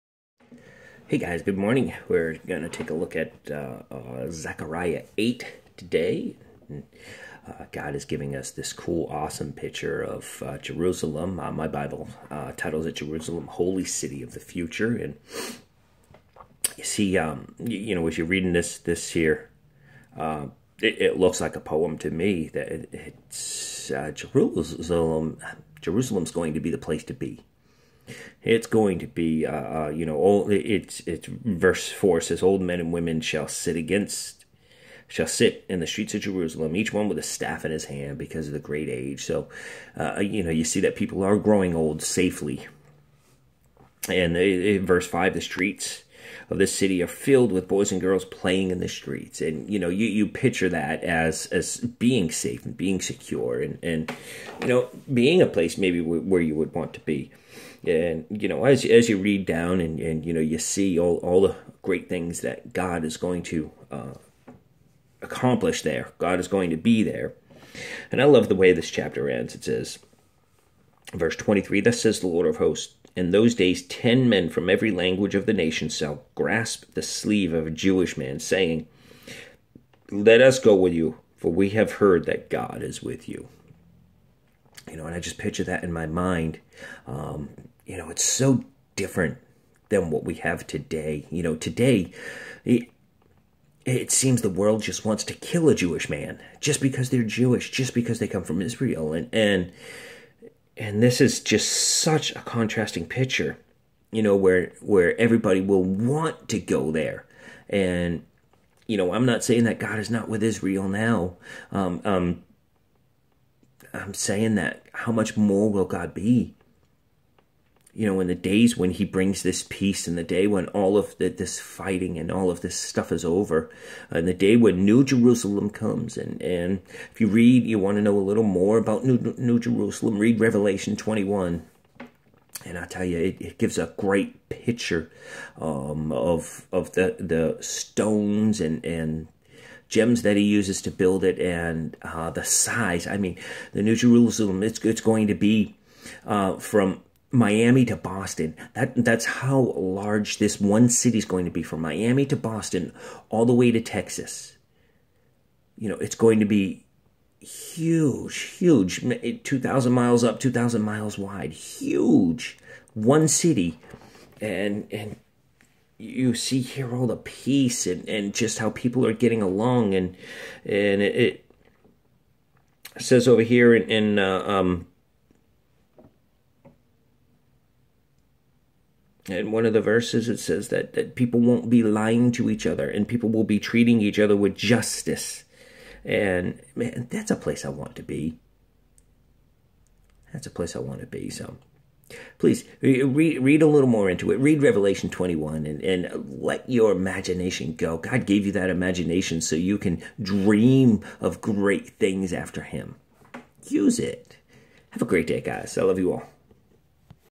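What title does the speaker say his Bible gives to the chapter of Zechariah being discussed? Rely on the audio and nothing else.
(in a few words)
Jerusalem, Holy City of the Future.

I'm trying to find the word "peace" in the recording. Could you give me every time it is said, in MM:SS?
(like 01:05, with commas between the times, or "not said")
01:59, 02:47.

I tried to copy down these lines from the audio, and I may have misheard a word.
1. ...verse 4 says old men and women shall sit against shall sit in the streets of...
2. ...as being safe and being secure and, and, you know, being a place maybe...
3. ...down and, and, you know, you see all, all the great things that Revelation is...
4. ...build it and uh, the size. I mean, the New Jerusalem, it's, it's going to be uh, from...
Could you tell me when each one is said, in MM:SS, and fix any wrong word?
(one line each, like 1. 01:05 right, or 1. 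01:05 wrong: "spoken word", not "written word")
1. 00:31 right
2. 00:51 right
3. 00:59 wrong: "God", not "Revelation"
4. 02:20 right.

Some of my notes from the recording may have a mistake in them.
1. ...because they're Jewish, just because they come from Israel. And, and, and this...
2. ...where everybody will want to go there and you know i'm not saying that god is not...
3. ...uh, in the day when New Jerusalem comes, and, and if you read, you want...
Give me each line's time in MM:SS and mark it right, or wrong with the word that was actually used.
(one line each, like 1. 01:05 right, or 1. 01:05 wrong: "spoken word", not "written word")
1. 01:36 right
2. 01:44 right
3. 02:04 right.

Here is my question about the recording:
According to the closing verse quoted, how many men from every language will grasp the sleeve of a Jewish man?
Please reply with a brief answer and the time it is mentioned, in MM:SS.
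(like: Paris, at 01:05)
10, at 01:13.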